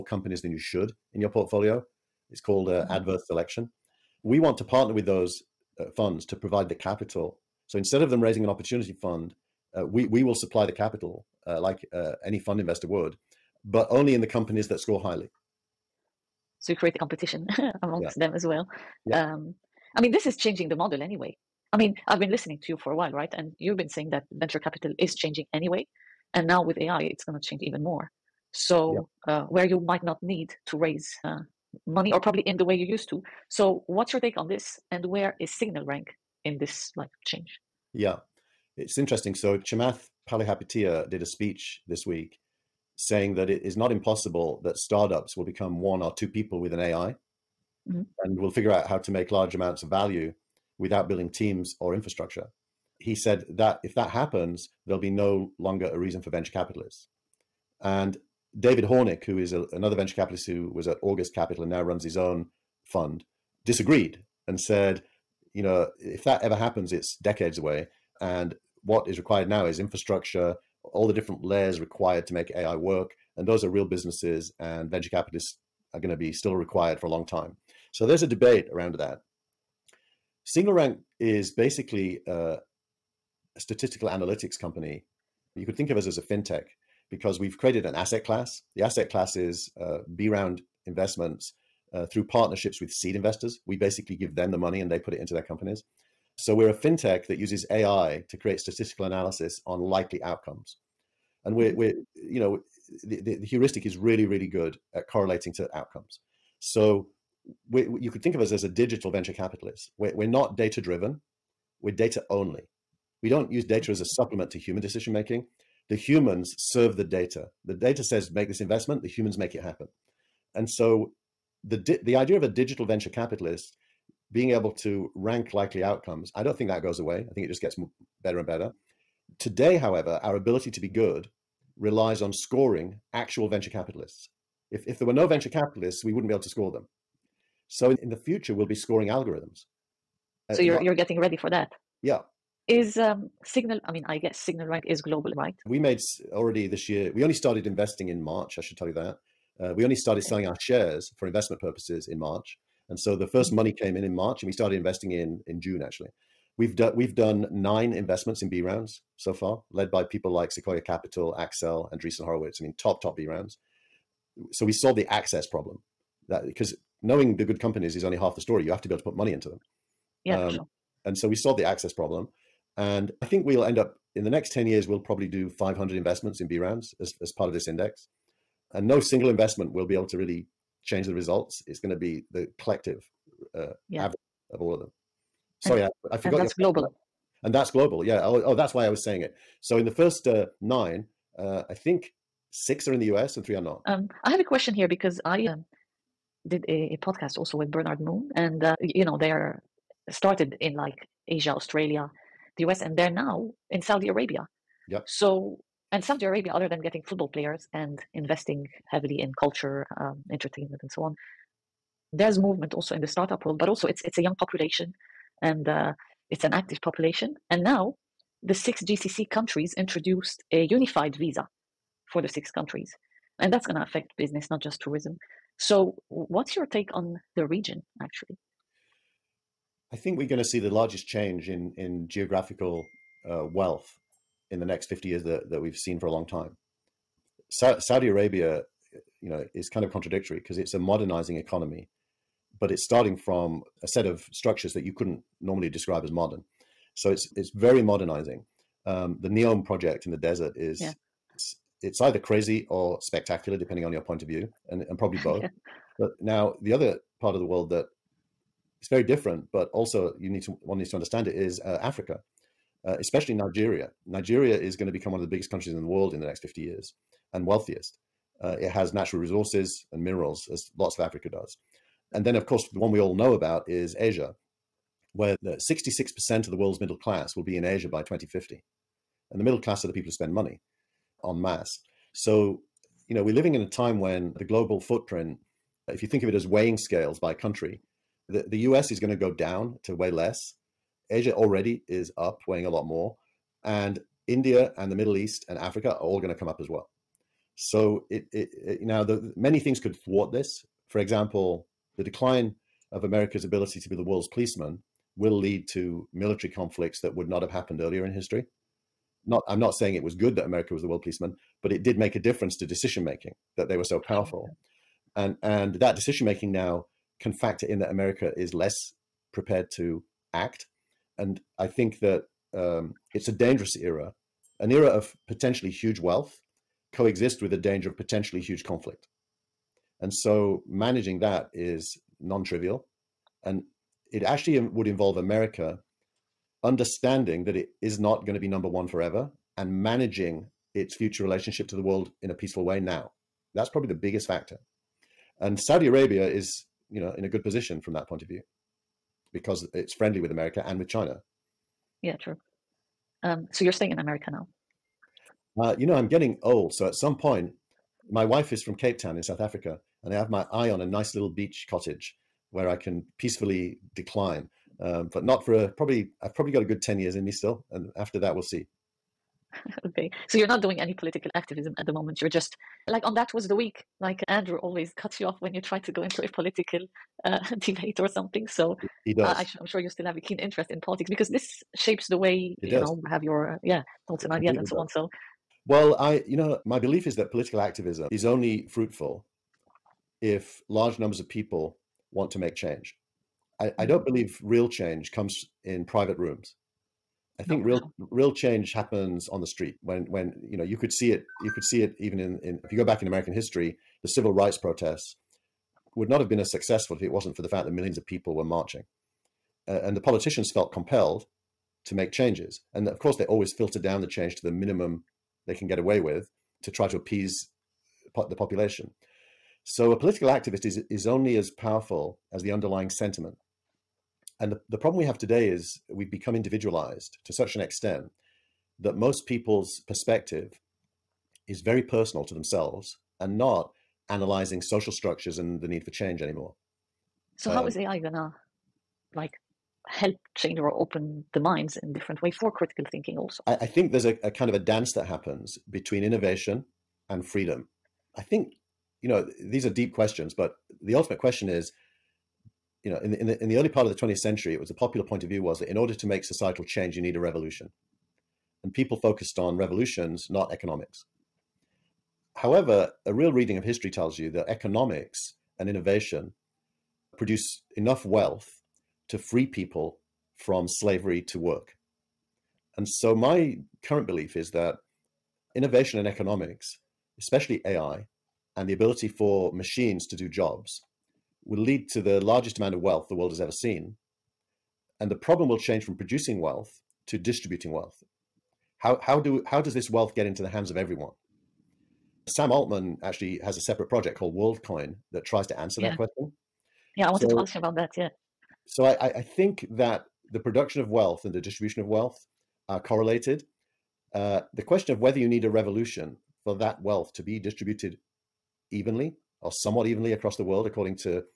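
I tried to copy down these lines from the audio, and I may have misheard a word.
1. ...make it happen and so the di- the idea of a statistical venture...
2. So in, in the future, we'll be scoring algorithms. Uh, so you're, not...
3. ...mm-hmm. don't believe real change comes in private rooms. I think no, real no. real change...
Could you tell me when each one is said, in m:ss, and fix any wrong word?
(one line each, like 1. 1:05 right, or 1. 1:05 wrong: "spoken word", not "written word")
1. 1:59 wrong: "digital", not "statistical"
2. 2:17 right
3. 6:33 right.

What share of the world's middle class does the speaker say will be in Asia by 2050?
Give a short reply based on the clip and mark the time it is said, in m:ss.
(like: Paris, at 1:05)
66%, at 4:35.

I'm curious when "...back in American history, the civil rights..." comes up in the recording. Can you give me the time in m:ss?
6:42.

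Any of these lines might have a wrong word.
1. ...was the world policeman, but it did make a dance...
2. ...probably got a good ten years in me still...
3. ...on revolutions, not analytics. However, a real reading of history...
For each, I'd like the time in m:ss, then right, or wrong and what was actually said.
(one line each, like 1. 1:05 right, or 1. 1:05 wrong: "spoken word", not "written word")
1. 5:10 wrong: "difference", not "dance"
2. 6:06 right
3. 7:39 wrong: "economics", not "analytics".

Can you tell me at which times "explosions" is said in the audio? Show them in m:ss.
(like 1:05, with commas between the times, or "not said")
not said.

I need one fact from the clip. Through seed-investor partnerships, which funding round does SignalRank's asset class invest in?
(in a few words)
B round.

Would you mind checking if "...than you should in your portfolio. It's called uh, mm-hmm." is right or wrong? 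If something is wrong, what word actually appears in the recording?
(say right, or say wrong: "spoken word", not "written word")
right.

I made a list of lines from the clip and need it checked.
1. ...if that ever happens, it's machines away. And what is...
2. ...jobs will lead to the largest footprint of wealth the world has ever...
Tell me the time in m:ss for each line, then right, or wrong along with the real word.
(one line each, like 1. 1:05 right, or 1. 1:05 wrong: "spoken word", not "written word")
1. 1:05 wrong: "decades", not "machines"
2. 8:00 wrong: "amount", not "footprint".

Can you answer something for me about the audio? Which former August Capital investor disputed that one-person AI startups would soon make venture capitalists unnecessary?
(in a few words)
David Hornik.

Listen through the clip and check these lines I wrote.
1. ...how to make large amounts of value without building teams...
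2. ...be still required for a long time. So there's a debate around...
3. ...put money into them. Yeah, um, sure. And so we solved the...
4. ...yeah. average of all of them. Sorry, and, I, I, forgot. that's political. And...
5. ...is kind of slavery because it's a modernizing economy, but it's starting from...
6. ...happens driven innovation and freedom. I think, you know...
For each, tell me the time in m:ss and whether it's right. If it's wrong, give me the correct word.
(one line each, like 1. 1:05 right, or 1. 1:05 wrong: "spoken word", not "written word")
1. 0:48 right
2. 1:16 right
3. 2:49 right
4. 3:03 wrong: "global", not "political"
5. 3:59 wrong: "contradictory", not "slavery"
6. 7:25 wrong: "between", not "driven".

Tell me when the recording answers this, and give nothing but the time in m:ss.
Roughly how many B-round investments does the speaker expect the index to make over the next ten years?
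2:55.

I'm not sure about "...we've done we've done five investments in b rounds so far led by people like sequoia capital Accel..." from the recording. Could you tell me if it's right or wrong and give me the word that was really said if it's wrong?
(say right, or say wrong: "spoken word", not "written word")
wrong: "nine", not "five".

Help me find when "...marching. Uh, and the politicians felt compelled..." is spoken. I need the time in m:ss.
6:48.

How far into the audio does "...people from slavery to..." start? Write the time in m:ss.
7:49.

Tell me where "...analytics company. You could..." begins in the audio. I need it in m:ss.
1:24.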